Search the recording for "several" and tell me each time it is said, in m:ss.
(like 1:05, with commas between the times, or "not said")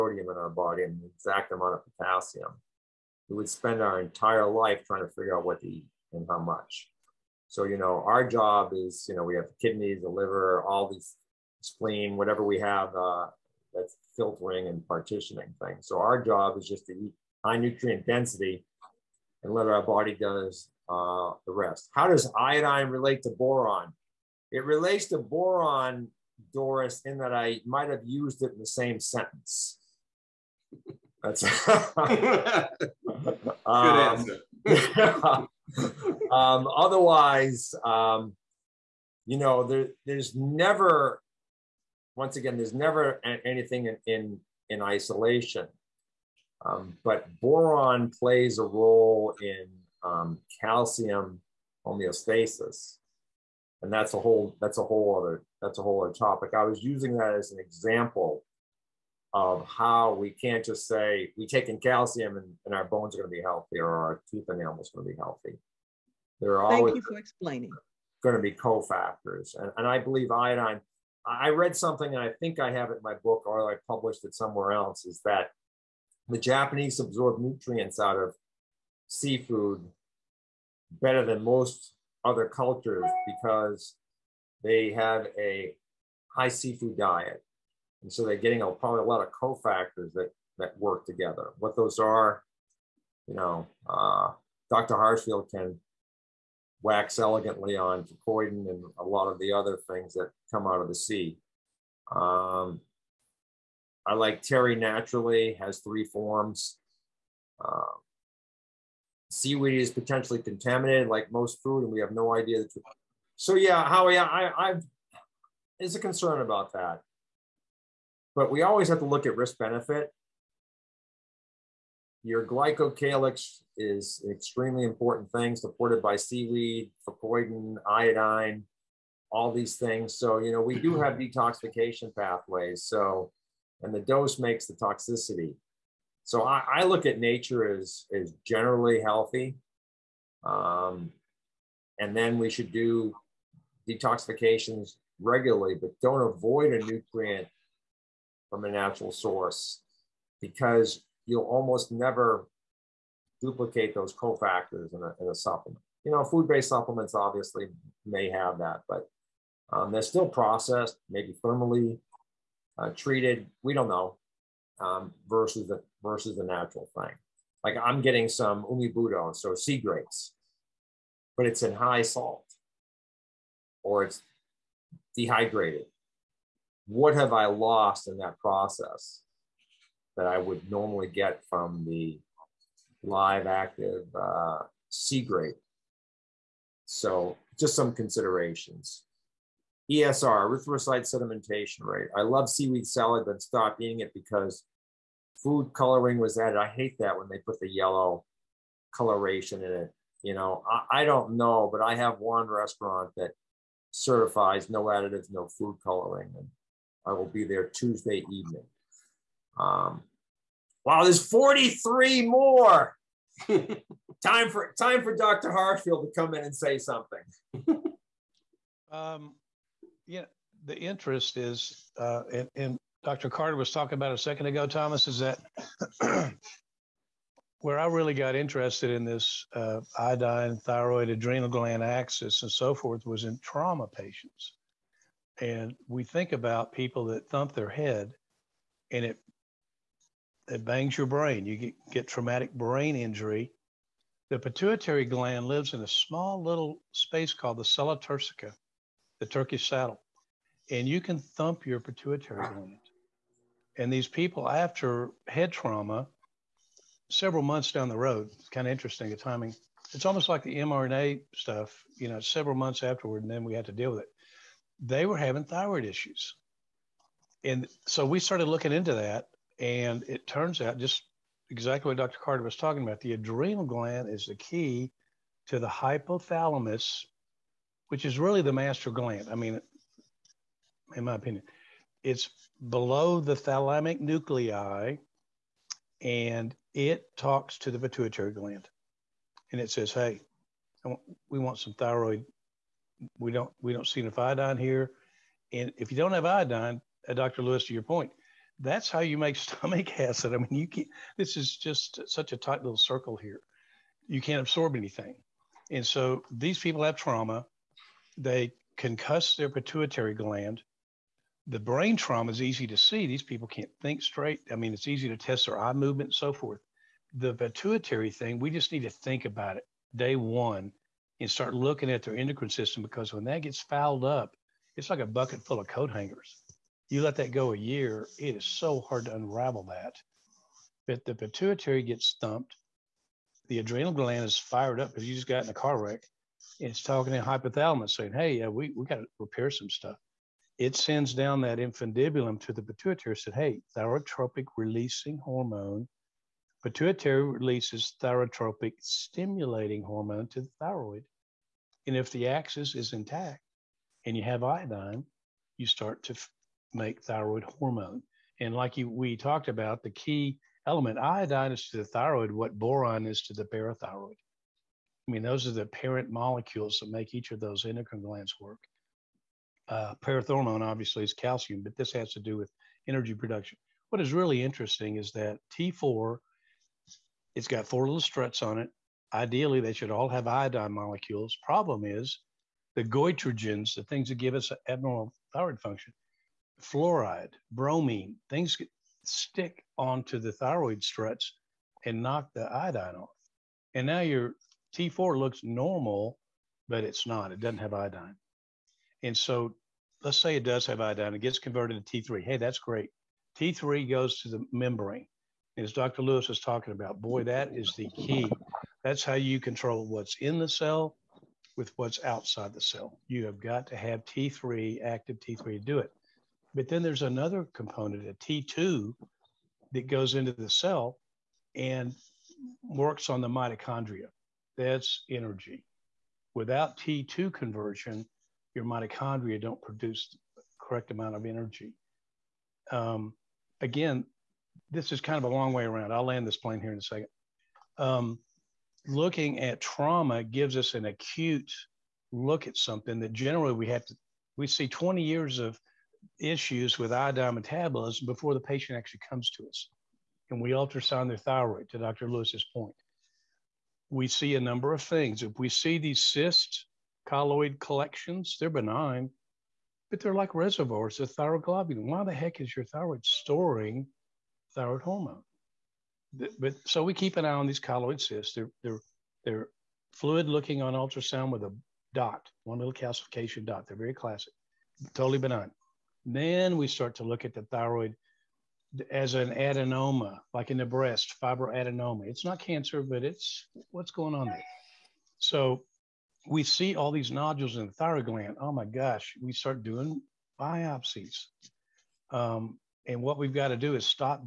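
4:17, 4:22.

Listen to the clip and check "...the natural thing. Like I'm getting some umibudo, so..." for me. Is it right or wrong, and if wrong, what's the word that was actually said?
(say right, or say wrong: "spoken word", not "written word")
right.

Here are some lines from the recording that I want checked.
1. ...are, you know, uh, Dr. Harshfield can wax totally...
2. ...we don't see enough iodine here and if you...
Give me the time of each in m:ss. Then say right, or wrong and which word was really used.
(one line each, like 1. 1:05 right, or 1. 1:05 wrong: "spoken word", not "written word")
1. 1:31 wrong: "elegantly", not "totally"
2. 4:53 right.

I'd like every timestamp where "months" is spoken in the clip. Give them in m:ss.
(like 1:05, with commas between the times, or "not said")
4:17, 4:22.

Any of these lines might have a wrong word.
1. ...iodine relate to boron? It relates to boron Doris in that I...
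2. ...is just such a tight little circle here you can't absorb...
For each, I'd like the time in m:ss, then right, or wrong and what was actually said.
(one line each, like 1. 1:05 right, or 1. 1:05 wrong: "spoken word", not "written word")
1. 0:22 right
2. 5:01 right.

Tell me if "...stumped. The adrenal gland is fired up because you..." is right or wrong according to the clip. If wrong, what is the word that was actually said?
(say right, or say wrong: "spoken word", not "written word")
right.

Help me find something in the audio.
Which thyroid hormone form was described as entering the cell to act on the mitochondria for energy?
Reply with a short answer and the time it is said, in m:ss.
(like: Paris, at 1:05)
T2, at 6:58.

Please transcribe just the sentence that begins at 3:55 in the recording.
And we think about people that thump their head and it, it bangs your brain.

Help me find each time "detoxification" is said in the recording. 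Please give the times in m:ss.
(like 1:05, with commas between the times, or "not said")
2:11, 2:23.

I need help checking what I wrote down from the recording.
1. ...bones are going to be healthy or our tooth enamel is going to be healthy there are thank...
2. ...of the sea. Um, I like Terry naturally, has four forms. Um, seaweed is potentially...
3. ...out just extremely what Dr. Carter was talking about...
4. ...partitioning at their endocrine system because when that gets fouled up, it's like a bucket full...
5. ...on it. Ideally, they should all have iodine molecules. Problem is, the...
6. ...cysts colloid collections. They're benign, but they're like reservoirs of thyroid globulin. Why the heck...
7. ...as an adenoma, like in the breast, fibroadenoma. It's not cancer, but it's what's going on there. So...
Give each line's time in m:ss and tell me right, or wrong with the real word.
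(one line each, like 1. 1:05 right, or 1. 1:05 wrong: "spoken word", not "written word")
1. 1:02 right
2. 1:40 wrong: "three", not "four"
3. 4:30 wrong: "exactly", not "extremely"
4. 5:21 wrong: "looking", not "partitioning"
5. 6:18 right
6. 7:36 right
7. 7:58 right.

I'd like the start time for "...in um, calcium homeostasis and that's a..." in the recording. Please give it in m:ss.
0:49.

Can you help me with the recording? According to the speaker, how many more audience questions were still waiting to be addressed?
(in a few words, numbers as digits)
43.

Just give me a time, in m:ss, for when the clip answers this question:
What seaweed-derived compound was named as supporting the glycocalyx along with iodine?
2:07.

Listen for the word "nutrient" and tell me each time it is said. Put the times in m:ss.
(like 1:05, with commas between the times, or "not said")
0:17, 1:17, 2:26.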